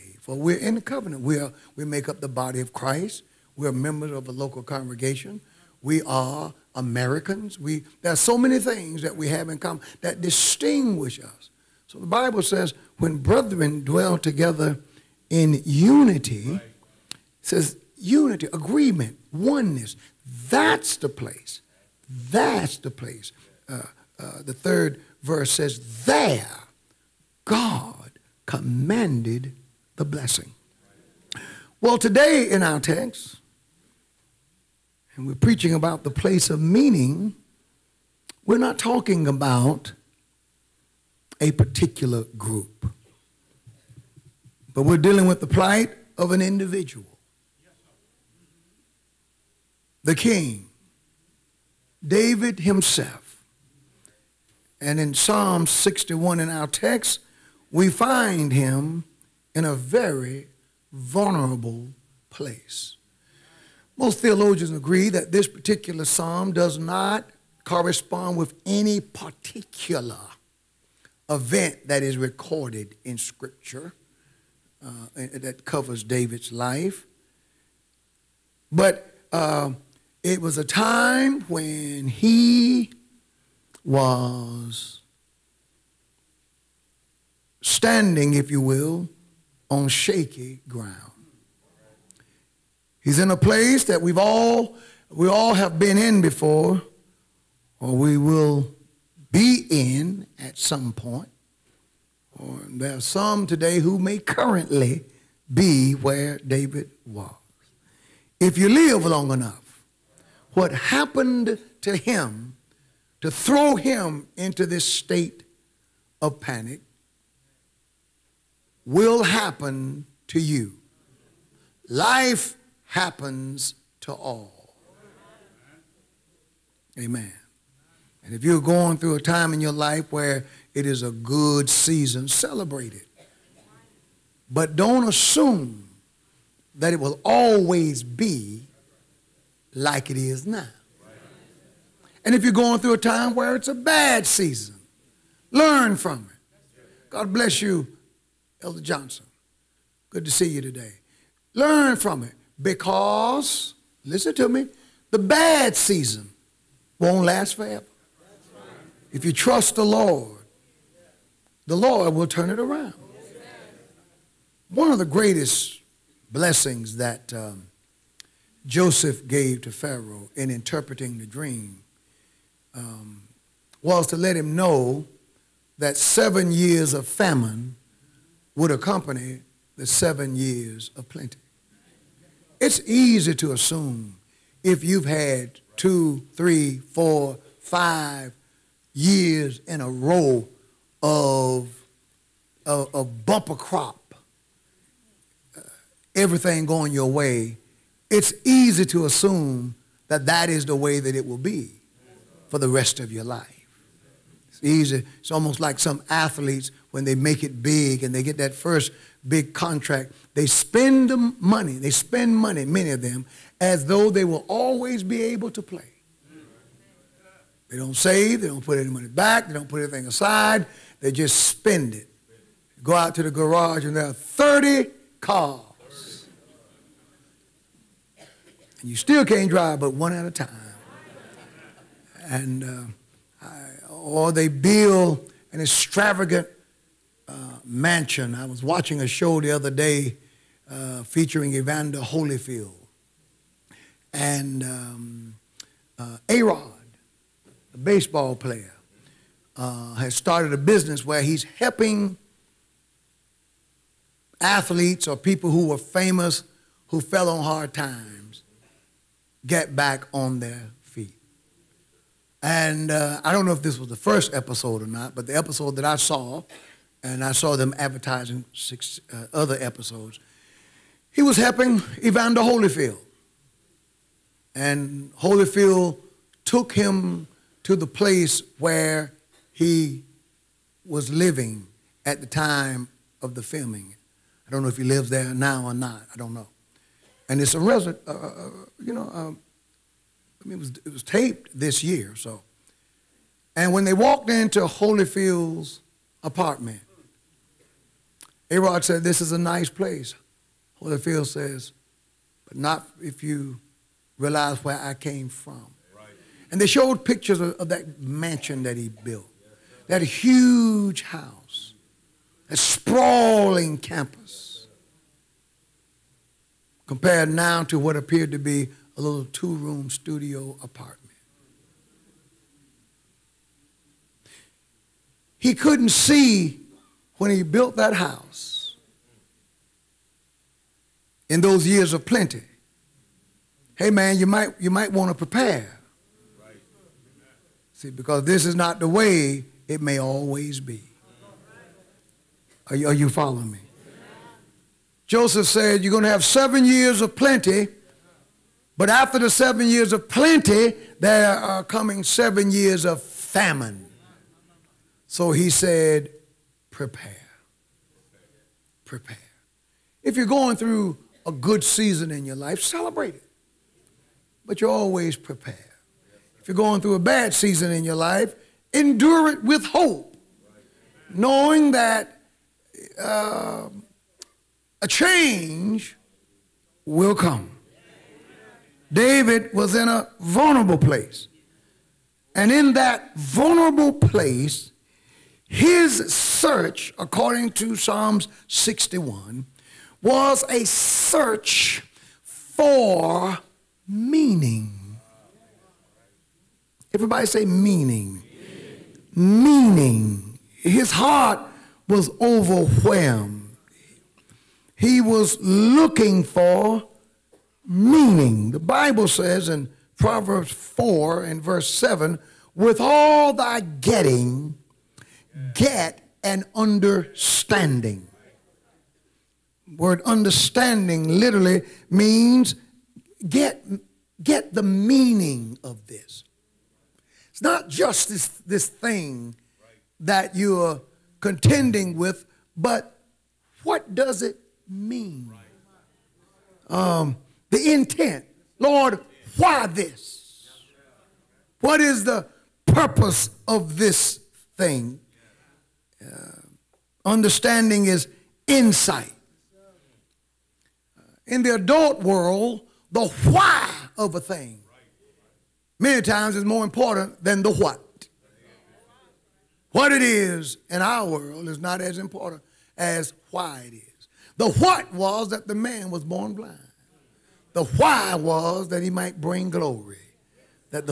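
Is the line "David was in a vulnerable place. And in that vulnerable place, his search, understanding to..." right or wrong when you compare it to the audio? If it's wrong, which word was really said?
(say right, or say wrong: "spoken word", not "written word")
wrong: "according", not "understanding".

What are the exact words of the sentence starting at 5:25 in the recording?
He couldn't see when he built that house in those years of plenty.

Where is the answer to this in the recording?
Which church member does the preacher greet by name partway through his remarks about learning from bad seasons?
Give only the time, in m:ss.
2:28.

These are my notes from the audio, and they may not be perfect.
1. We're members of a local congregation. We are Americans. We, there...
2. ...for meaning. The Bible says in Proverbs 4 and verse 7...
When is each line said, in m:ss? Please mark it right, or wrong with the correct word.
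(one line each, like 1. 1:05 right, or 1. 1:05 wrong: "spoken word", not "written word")
1. 0:03 right
2. 6:46 right.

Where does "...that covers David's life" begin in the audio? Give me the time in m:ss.
1:15.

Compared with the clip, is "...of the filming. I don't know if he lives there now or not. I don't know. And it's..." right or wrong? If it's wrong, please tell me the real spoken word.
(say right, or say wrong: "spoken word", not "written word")
right.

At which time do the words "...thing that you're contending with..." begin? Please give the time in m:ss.
7:08.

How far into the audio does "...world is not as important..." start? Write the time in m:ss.
7:41.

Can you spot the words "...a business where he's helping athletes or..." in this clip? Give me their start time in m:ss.
4:10.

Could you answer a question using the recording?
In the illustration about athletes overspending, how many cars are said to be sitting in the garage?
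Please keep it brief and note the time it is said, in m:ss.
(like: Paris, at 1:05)
30, at 3:44.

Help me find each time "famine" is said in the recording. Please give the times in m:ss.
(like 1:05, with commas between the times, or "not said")
2:57, 5:53.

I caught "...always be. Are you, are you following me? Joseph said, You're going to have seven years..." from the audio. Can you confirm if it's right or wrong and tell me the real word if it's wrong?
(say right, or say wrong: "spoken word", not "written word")
right.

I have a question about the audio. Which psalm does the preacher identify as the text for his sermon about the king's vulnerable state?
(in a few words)
Psalm 61.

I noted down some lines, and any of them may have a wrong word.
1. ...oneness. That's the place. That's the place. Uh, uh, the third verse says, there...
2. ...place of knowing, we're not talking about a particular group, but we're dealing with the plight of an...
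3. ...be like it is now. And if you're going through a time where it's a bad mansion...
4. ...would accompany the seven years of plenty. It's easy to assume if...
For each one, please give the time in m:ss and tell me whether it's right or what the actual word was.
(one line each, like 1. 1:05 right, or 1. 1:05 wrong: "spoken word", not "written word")
1. 0:19 right
2. 0:36 wrong: "meaning", not "knowing"
3. 2:18 wrong: "season", not "mansion"
4. 2:58 right.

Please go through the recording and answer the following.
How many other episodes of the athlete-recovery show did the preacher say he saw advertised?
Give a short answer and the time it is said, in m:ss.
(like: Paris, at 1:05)
6, at 4:28.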